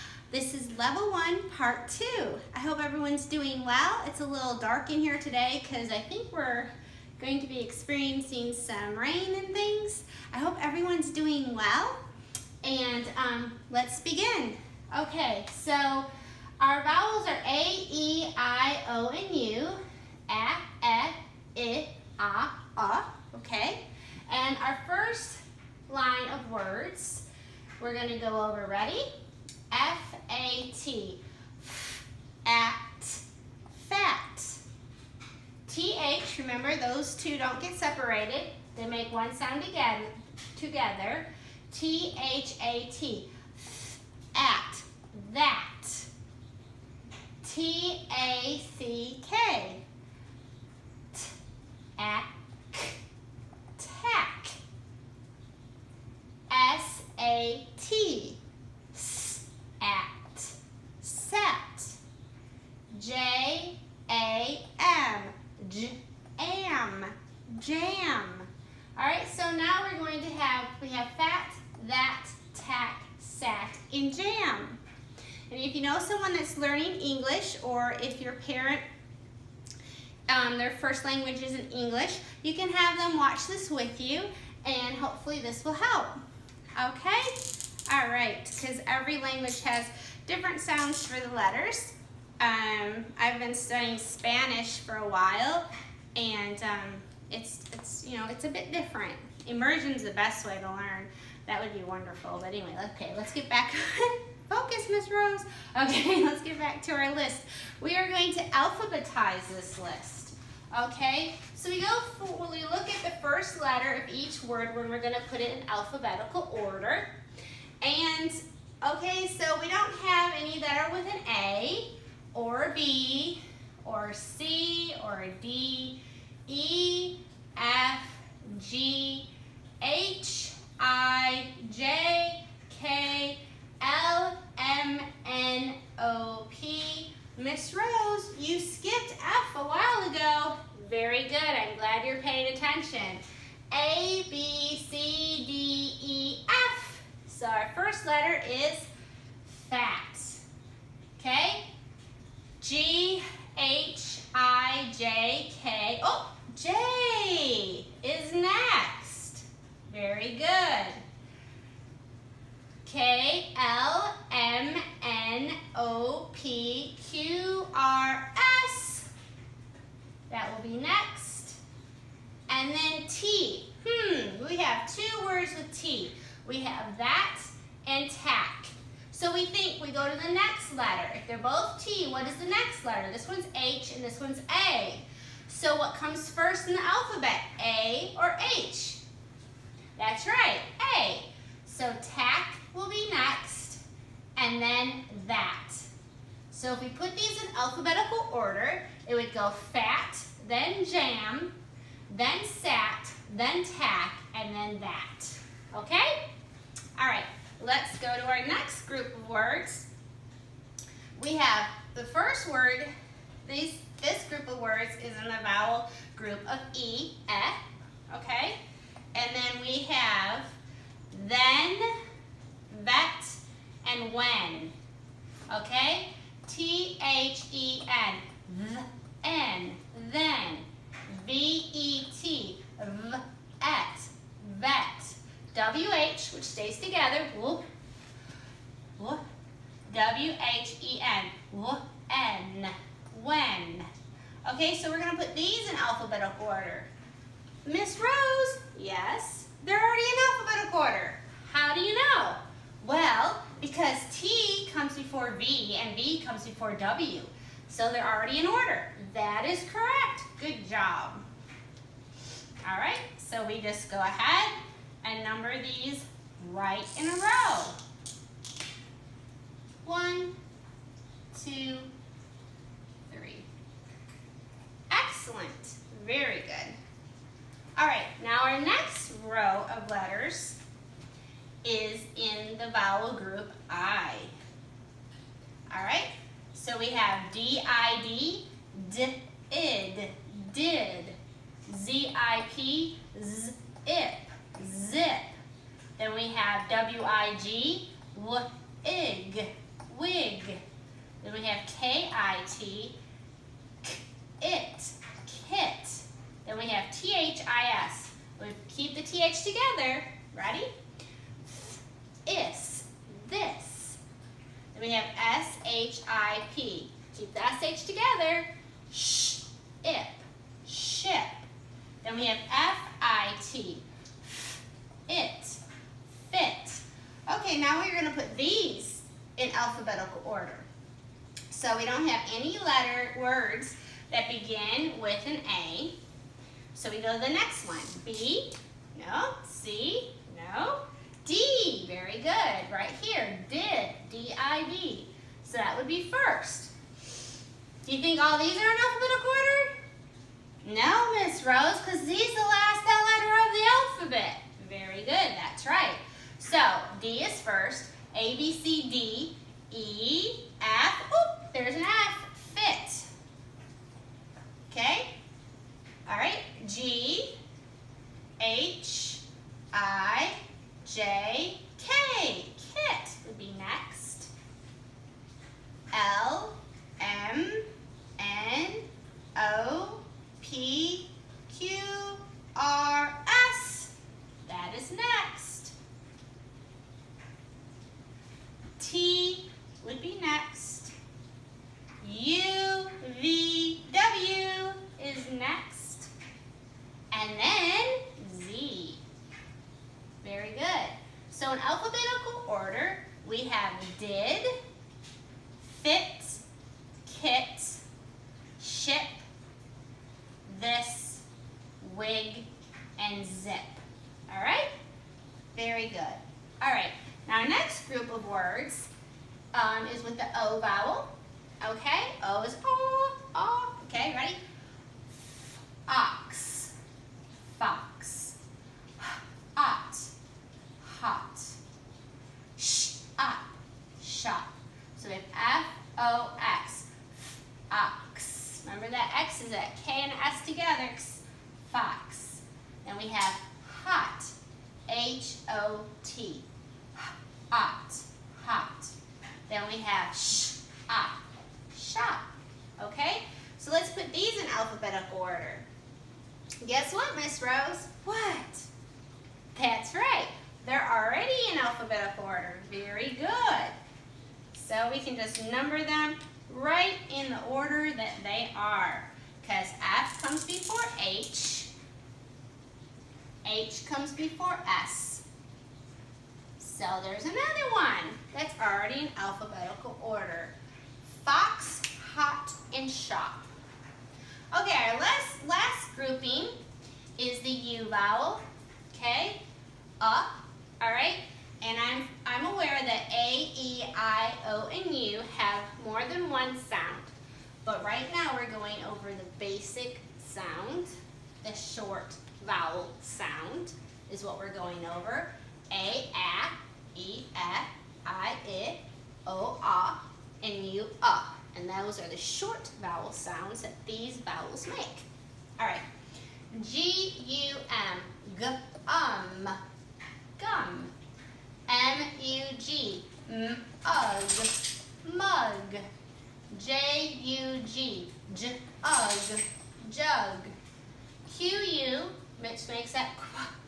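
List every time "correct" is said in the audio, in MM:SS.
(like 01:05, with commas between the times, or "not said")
04:19.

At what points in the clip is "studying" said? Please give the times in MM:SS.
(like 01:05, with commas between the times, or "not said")
01:33.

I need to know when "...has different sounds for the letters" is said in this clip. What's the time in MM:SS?
01:29.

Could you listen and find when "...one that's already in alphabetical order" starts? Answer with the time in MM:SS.
07:57.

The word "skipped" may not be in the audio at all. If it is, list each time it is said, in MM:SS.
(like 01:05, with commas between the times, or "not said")
02:18.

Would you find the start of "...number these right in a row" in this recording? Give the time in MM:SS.
04:25.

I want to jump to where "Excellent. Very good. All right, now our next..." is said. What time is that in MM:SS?
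04:34.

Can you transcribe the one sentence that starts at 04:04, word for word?
Okay, so we're gonna put these in alphabetical order.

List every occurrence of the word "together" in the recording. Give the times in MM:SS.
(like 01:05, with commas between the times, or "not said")
00:40, 03:56, 05:09, 05:17, 07:20.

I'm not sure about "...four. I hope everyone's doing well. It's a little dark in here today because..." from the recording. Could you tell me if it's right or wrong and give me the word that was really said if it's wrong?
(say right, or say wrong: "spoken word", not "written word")
wrong: "two", not "four".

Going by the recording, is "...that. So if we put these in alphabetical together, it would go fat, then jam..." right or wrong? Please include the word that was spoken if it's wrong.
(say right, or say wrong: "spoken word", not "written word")
wrong: "order", not "together".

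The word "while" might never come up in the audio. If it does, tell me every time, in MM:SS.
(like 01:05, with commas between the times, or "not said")
01:35, 02:19.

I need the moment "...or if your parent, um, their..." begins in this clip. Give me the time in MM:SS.
01:17.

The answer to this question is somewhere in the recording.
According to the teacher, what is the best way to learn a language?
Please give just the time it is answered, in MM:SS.
01:39.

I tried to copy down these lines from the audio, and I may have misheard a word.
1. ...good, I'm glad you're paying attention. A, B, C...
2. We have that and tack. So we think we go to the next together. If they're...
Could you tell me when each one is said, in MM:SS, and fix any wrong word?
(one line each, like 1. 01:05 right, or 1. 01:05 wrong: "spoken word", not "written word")
1. 02:21 right
2. 02:56 wrong: "letter", not "together".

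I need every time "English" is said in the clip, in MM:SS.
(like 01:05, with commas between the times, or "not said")
01:16, 01:21.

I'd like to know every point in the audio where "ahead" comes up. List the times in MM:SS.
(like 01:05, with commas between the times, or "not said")
04:23.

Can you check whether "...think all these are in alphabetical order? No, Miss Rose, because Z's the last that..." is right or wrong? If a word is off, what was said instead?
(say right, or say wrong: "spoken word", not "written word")
right.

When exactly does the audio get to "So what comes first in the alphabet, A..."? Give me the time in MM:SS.
03:05.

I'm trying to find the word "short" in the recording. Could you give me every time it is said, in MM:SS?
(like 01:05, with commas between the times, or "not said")
08:21, 08:32.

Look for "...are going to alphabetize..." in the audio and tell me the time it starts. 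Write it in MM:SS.
01:47.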